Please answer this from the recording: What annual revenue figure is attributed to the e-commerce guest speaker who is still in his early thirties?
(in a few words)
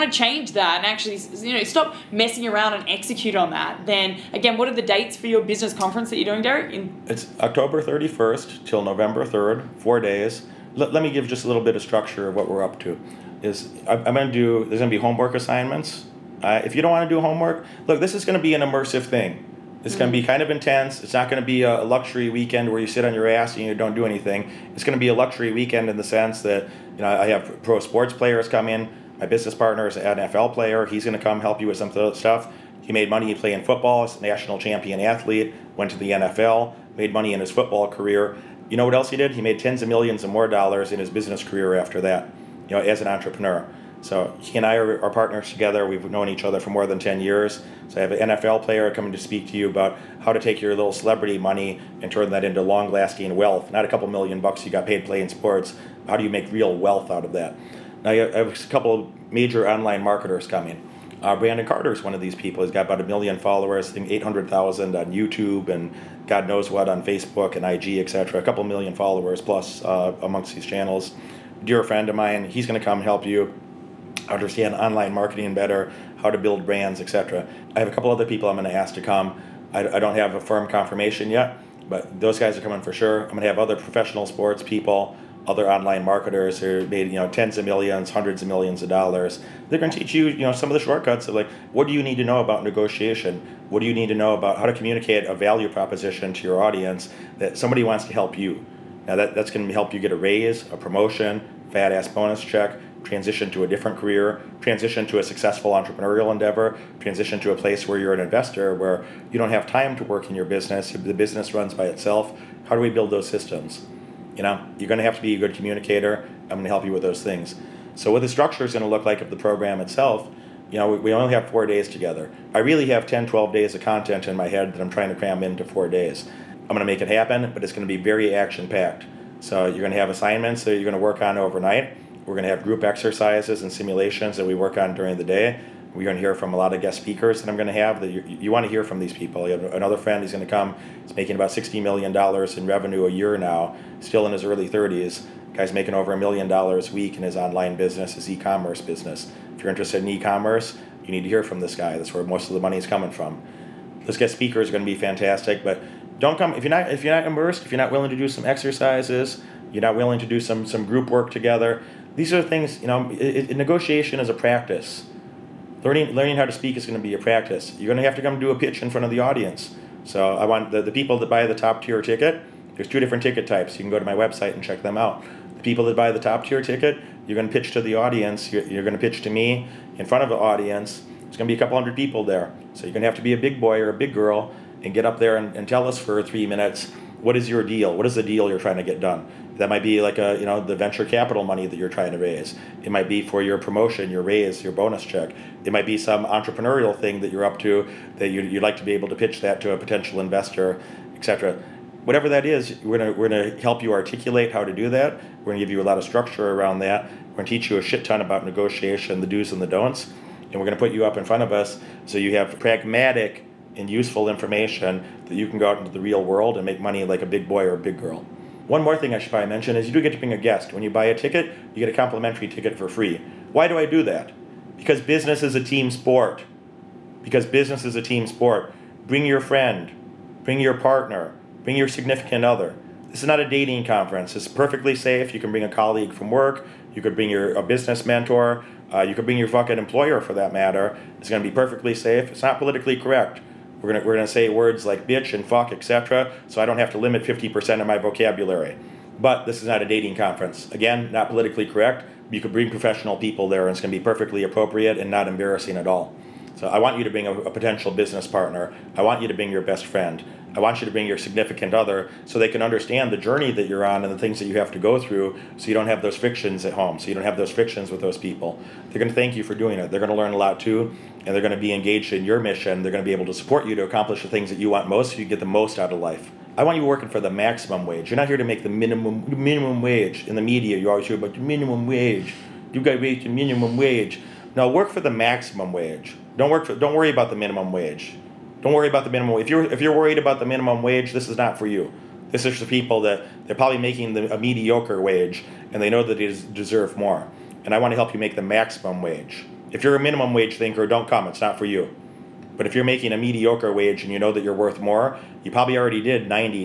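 $60 million.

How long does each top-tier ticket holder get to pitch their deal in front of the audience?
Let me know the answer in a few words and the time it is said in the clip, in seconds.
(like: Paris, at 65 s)
3 minutes, at 186 s.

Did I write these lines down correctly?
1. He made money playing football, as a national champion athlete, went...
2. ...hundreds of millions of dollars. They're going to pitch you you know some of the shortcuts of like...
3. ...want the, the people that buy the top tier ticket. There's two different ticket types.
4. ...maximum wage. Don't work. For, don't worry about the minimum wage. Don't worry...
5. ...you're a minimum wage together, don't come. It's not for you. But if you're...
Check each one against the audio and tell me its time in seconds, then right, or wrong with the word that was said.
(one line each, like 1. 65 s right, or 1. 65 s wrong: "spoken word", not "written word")
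1. 32 s right
2. 88 s wrong: "teach", not "pitch"
3. 170 s right
4. 285 s right
5. 299 s wrong: "thinker", not "together".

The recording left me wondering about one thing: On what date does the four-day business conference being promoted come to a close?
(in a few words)
November 3rd.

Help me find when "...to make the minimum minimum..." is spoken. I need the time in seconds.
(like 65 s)
278 s.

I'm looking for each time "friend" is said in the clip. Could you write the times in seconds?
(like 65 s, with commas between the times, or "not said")
71 s, 139 s, 229 s, 259 s.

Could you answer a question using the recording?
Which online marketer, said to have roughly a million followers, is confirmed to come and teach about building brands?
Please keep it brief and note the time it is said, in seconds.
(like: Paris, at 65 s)
Brandon Carter, at 61 s.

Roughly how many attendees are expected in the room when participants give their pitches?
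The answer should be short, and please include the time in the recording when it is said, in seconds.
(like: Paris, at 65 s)
a couple hundred, at 181 s.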